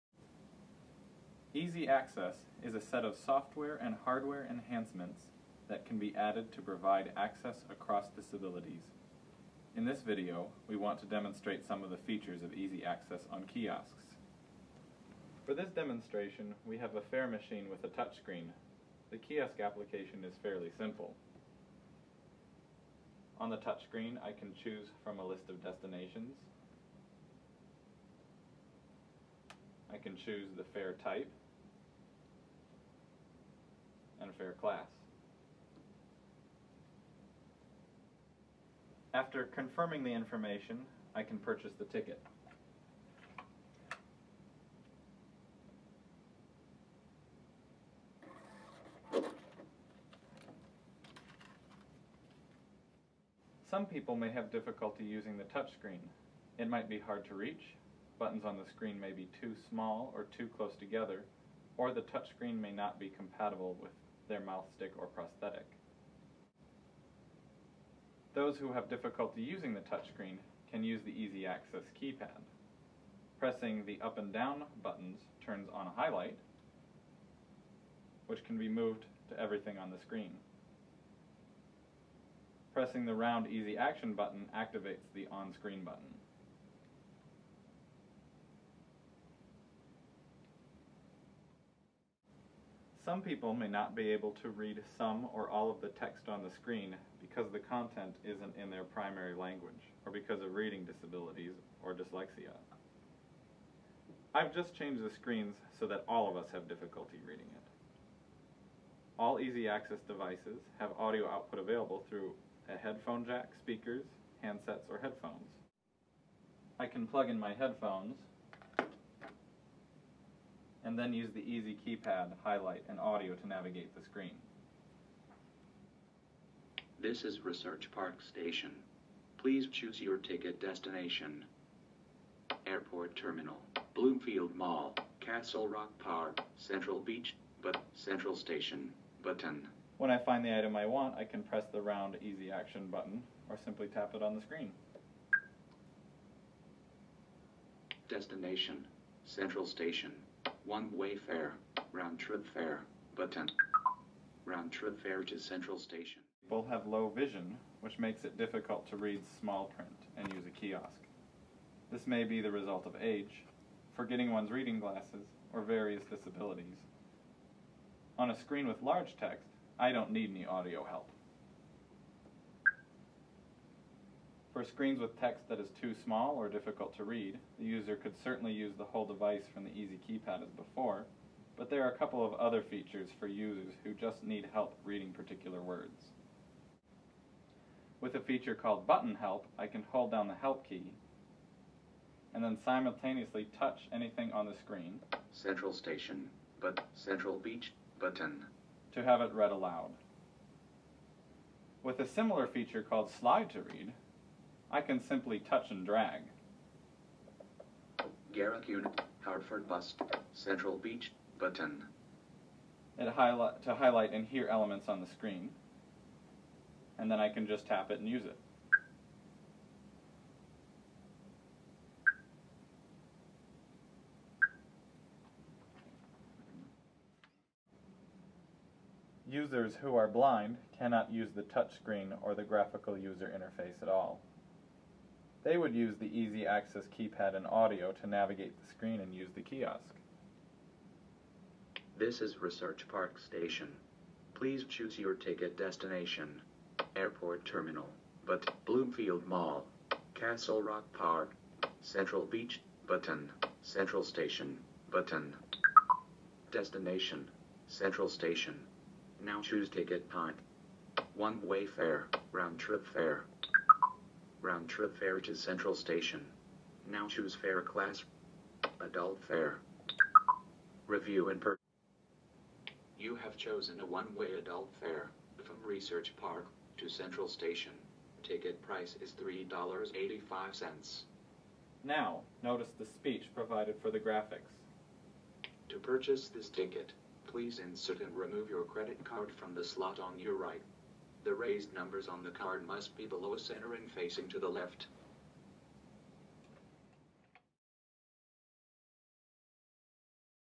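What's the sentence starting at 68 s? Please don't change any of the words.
Those who have difficulty using the touchscreen can use the EZ Access keypad.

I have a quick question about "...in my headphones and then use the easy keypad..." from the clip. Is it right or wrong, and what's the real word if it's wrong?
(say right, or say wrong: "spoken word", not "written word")
right.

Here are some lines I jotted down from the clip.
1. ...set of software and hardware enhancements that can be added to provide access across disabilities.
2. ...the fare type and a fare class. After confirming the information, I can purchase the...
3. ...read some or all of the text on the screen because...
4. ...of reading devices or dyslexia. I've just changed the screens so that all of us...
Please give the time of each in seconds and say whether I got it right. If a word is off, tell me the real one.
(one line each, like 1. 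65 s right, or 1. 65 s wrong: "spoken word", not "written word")
1. 2 s right
2. 30 s right
3. 94 s right
4. 100 s wrong: "disabilities", not "devices".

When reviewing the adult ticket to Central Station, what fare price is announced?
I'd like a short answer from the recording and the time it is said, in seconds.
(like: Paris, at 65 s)
$3.85, at 279 s.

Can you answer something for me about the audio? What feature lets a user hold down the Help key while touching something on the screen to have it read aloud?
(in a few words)
Button Help.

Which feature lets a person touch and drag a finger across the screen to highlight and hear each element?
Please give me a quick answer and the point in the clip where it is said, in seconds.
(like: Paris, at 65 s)
Slide to Read, at 203 s.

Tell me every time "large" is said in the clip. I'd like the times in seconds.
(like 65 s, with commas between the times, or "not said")
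168 s.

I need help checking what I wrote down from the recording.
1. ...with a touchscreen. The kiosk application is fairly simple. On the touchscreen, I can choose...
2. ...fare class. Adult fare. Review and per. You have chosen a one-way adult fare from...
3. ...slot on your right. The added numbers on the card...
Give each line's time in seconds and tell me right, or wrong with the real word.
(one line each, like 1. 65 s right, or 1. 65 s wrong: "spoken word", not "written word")
1. 17 s right
2. 267 s right
3. 289 s wrong: "raised", not "added".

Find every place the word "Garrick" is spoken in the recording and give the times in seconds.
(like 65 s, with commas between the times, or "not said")
208 s.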